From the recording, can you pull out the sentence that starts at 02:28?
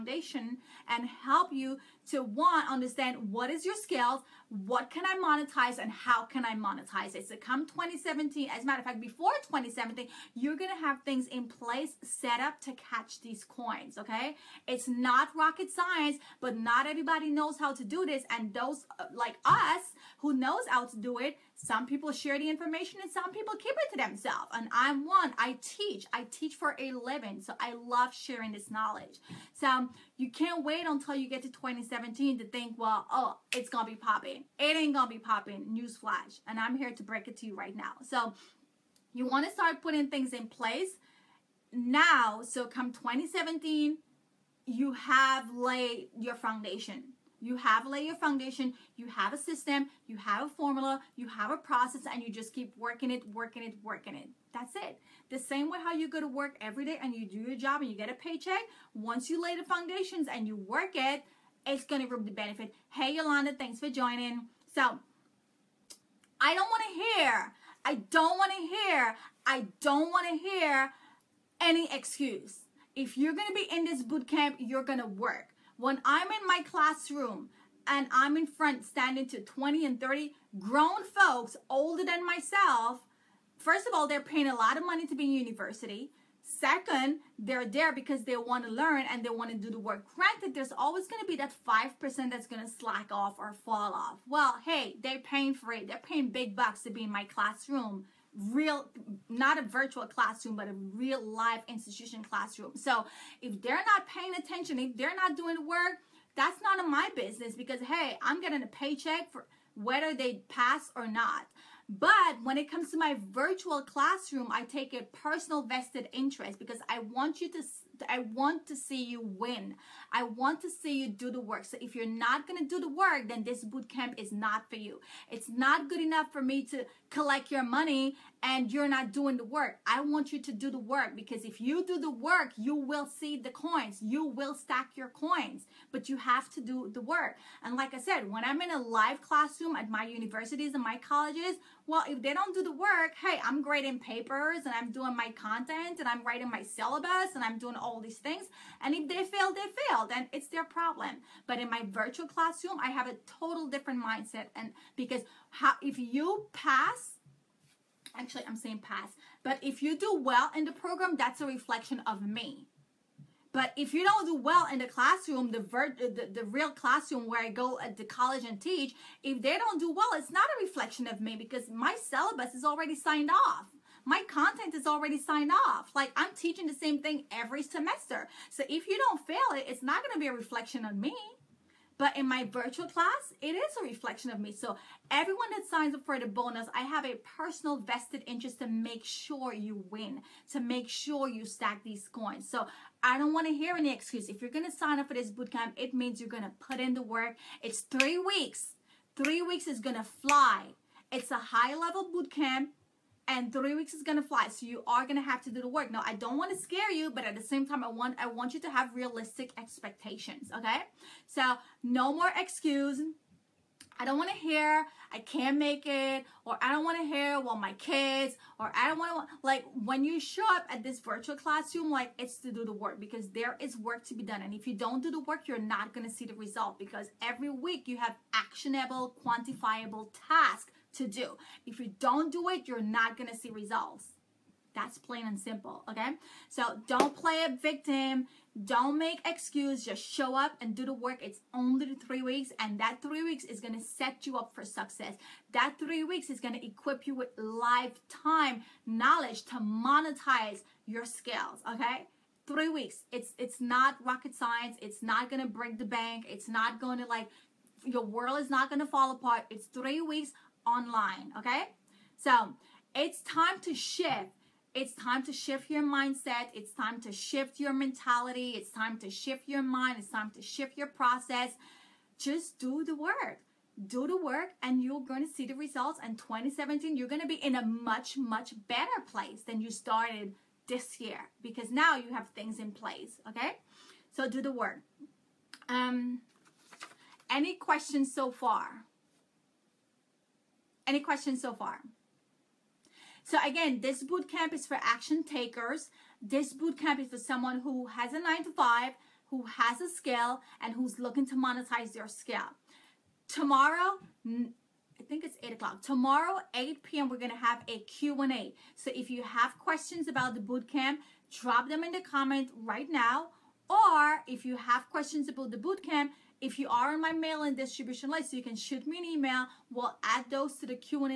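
And if they fail, they fail.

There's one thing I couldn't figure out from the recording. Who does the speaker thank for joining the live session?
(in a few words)
Yolanda.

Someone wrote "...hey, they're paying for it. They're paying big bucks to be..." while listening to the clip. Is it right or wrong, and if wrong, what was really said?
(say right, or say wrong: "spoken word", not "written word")
right.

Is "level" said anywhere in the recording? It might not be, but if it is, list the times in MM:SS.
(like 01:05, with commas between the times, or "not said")
03:21.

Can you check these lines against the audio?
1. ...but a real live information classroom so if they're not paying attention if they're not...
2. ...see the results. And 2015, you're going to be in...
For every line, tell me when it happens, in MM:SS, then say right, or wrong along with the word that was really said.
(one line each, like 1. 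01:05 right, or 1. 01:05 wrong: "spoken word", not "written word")
1. 01:40 wrong: "institution", not "information"
2. 04:35 wrong: "2017", not "2015".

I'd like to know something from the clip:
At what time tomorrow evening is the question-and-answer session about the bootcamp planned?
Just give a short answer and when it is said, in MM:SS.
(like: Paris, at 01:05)
8 p.m., at 05:06.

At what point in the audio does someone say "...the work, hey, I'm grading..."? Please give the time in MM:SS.
02:22.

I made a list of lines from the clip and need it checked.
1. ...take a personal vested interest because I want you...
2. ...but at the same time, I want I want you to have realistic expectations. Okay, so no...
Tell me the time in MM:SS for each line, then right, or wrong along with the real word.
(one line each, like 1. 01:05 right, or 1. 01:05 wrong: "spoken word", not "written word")
1. 01:54 right
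2. 03:27 right.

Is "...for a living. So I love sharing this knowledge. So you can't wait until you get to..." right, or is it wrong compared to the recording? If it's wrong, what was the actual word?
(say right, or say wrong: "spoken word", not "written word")
right.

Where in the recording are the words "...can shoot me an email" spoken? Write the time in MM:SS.
05:18.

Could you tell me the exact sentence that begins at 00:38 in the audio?
So you want to start putting things in place now.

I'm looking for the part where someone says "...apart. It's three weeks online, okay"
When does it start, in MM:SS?
04:19.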